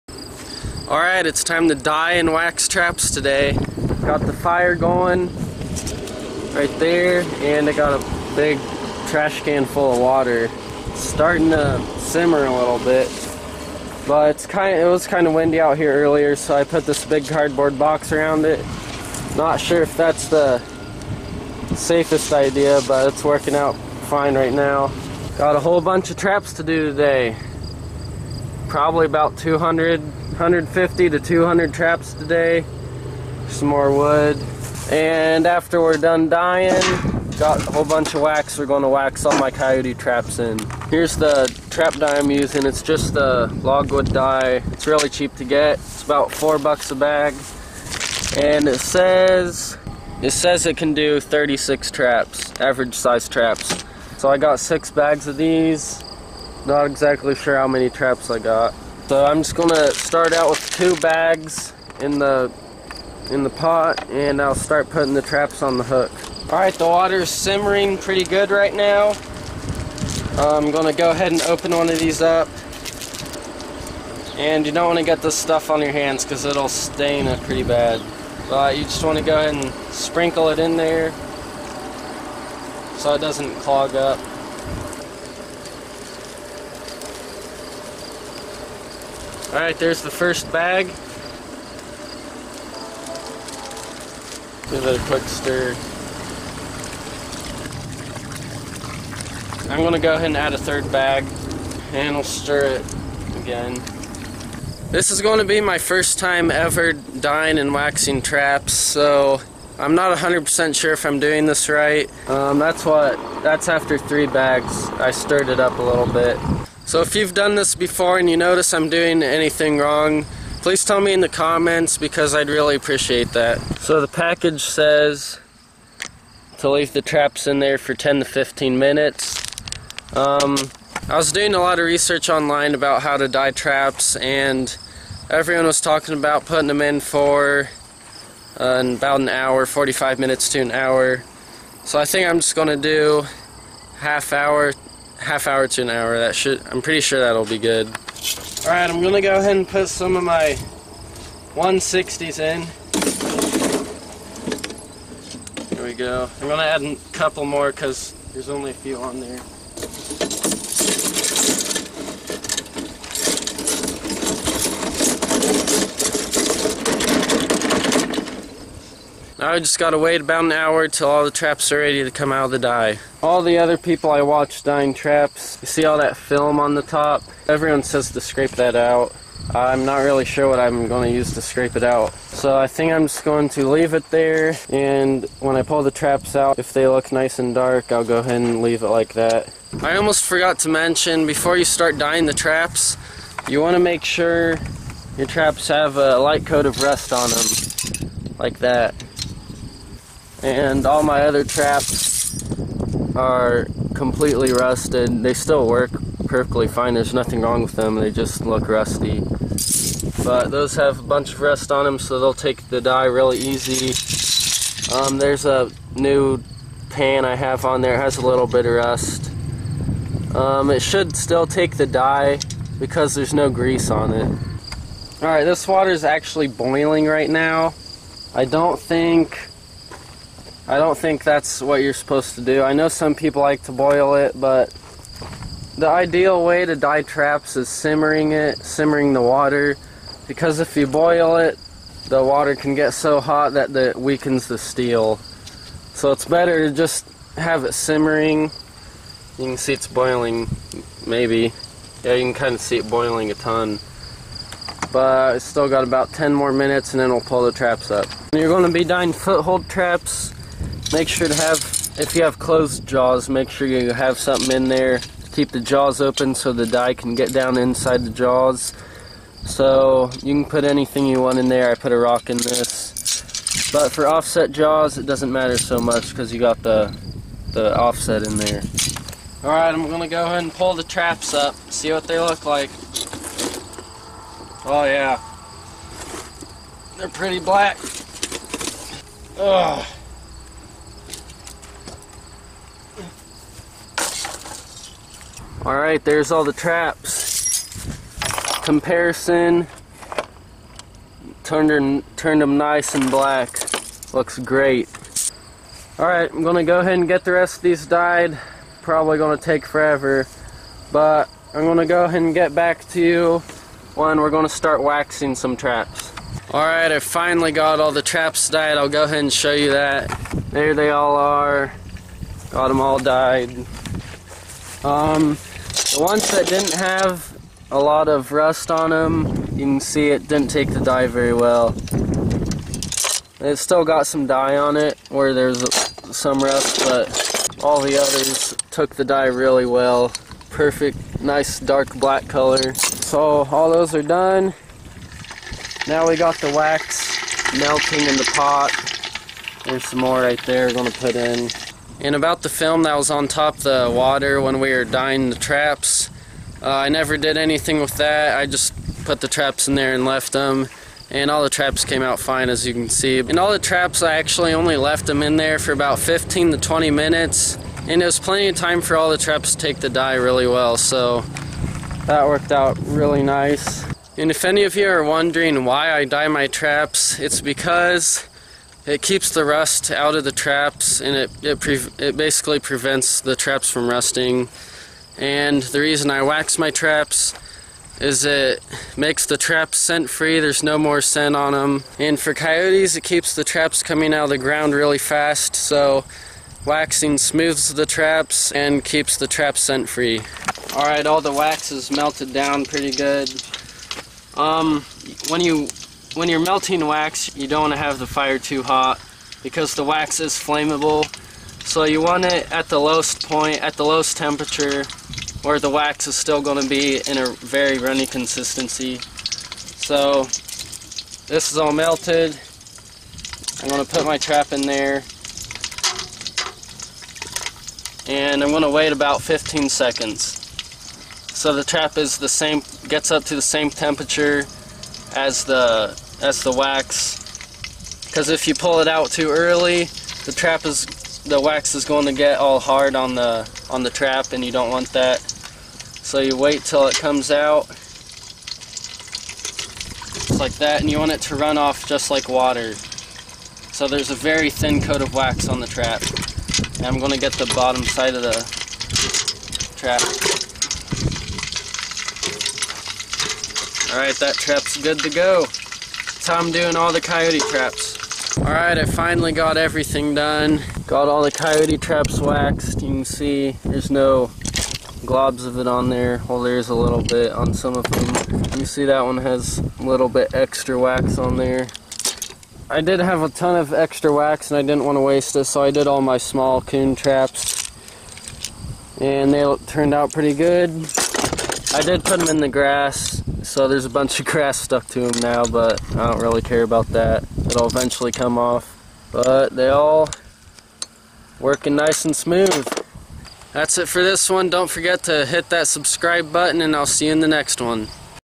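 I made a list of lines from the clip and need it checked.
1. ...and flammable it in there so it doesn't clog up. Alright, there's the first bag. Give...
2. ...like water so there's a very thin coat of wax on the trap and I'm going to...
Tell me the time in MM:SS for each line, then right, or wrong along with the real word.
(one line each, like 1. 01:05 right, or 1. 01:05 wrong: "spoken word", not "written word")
1. 01:19 wrong: "sprinkle", not "flammable"
2. 07:32 right.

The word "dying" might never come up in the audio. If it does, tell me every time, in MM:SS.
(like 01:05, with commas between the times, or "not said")
00:36, 05:54.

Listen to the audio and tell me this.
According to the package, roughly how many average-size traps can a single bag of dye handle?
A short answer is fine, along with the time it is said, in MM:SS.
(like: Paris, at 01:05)
36, at 00:51.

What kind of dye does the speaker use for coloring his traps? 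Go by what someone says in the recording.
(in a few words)
logwood dye.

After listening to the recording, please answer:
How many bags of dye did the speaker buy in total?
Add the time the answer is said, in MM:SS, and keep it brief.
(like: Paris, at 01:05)
6, at 00:54.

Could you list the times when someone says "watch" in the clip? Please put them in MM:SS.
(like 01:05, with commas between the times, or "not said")
02:54.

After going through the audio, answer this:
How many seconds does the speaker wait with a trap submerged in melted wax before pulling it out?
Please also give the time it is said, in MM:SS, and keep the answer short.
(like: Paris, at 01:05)
15 seconds, at 07:09.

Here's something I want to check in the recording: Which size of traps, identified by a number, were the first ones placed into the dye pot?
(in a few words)
160s.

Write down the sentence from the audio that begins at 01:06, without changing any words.
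Alright, the water's simmering pretty good right now.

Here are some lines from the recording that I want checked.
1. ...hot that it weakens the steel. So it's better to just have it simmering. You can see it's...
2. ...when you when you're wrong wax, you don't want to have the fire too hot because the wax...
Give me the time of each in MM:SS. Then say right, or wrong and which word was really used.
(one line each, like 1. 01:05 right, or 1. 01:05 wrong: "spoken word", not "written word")
1. 04:03 right
2. 06:45 wrong: "melting", not "wrong".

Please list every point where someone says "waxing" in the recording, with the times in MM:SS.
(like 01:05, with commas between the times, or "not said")
01:47, 05:14, 06:36.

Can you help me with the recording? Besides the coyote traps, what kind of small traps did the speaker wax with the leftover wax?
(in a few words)
coon traps.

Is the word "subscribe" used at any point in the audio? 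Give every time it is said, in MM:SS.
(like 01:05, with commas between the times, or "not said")
08:25.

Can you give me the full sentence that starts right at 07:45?
That's how I'm doing all the coyote traps.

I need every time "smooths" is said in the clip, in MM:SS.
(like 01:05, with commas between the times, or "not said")
06:37, 08:22.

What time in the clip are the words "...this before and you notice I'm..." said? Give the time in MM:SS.
01:57.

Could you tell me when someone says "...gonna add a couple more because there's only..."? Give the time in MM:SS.
02:36.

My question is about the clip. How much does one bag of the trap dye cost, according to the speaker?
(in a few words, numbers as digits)
4 bucks.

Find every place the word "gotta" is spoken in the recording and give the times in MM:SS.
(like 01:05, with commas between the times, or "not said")
02:49.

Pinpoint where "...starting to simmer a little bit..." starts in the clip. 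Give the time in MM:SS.
00:11.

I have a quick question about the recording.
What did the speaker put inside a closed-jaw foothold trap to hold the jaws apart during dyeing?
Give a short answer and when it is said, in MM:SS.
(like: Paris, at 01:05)
a rock, at 04:31.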